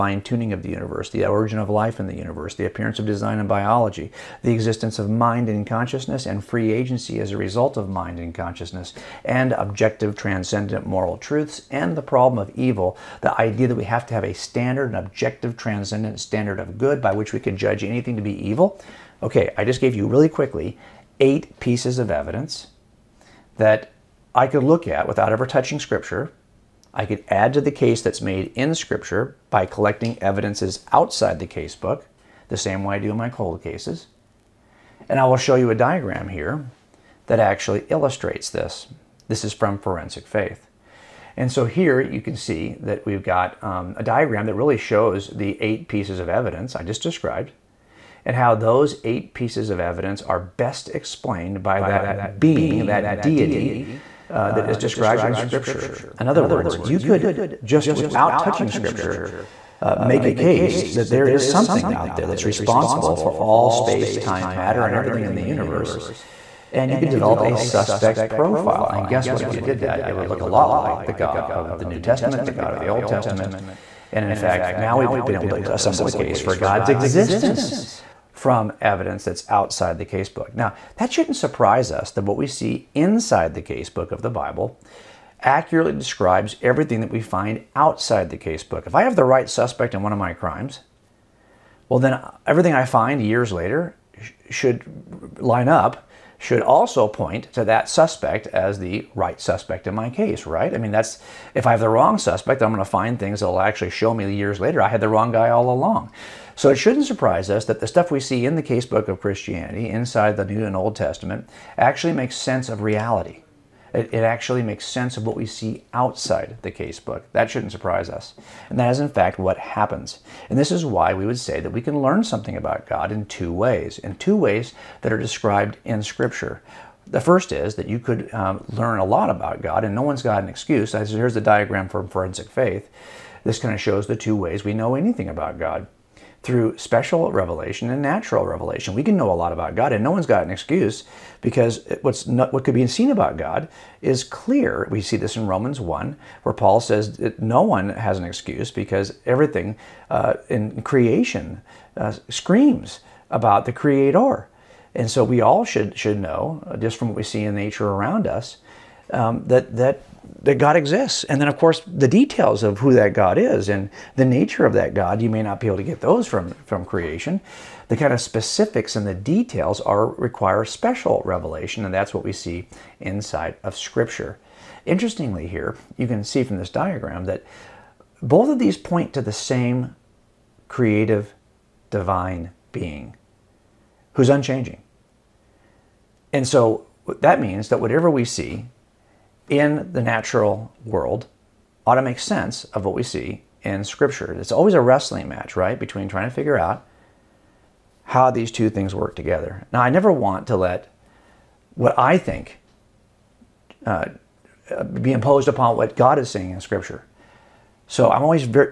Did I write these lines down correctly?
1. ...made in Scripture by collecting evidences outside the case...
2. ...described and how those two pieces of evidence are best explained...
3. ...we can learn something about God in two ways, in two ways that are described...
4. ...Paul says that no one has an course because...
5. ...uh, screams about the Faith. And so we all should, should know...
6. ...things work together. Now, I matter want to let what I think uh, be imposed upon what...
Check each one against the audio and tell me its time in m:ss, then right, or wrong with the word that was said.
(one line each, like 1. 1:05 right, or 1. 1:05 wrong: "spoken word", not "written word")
1. 0:28 right
2. 0:47 wrong: "eight", not "two"
3. 2:01 right
4. 2:26 wrong: "excuse", not "course"
5. 2:31 wrong: "Creator", not "Faith"
6. 3:18 wrong: "never", not "matter".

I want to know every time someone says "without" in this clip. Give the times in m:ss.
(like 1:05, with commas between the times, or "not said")
0:25, 0:57.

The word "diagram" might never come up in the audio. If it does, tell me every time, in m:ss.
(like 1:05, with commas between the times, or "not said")
0:35, 0:44, 2:11, 2:56.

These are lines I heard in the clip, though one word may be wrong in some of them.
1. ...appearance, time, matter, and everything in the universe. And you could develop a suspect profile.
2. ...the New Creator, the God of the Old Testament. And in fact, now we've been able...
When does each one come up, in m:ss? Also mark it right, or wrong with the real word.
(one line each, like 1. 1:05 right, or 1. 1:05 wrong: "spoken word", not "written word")
1. 1:03 wrong: "space", not "appearance"
2. 1:11 wrong: "Testament", not "Creator".